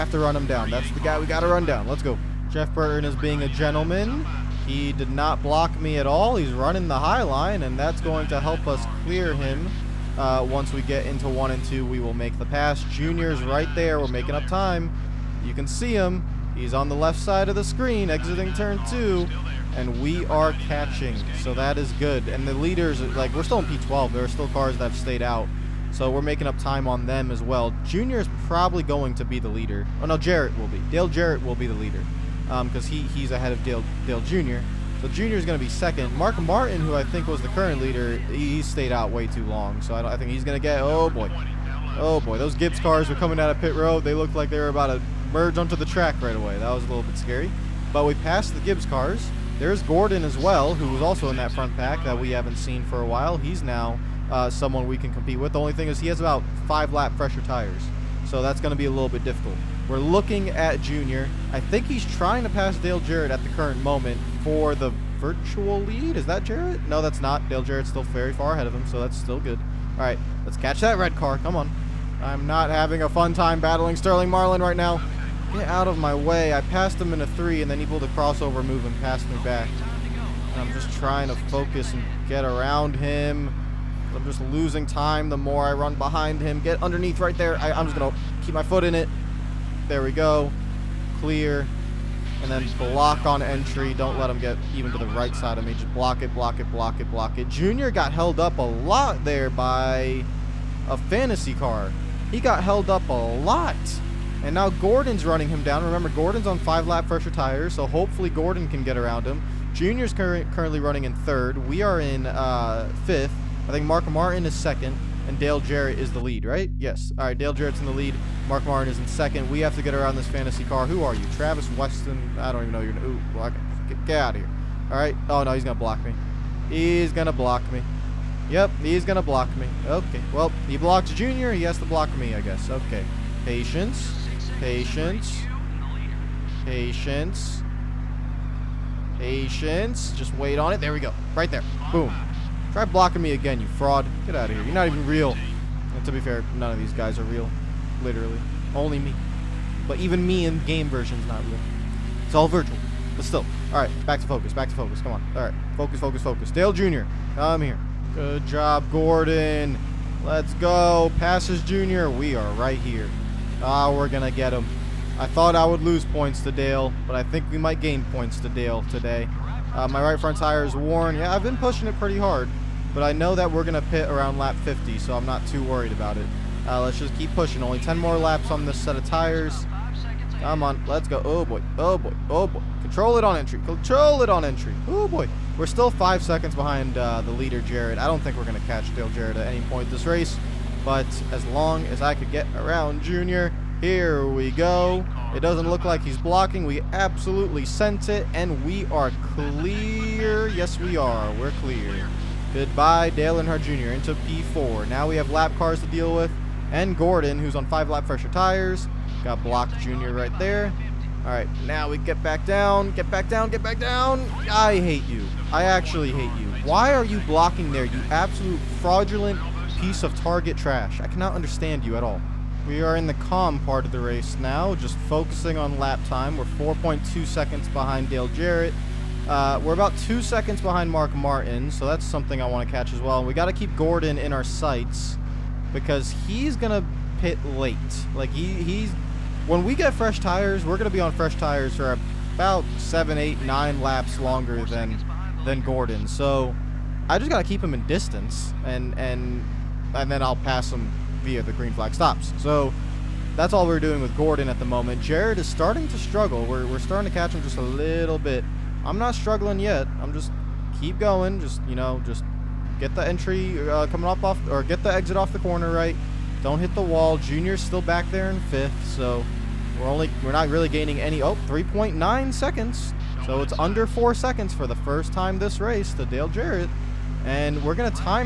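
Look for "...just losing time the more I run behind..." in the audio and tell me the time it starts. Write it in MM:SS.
01:24.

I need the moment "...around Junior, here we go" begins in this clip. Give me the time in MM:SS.
03:12.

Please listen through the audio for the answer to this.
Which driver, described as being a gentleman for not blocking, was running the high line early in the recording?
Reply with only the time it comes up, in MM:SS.
00:02.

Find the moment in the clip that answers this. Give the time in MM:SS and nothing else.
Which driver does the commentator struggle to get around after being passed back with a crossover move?
01:13.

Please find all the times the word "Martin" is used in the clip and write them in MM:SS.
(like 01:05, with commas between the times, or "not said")
00:36, 01:54, 01:58, 03:51.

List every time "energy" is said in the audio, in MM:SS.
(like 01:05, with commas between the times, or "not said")
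not said.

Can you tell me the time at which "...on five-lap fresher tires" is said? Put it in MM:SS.
03:27.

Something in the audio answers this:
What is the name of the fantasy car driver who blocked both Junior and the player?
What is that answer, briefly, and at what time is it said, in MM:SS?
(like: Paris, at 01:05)
Travis Weston, at 02:01.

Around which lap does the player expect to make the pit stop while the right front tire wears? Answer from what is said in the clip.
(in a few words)
50.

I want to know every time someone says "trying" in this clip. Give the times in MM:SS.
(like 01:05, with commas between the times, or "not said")
01:02, 01:20.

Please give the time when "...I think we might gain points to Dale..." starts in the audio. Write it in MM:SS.
02:47.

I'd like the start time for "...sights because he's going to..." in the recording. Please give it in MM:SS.
03:54.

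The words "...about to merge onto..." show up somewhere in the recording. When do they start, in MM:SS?
00:44.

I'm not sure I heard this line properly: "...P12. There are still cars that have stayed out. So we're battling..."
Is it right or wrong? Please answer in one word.
wrong.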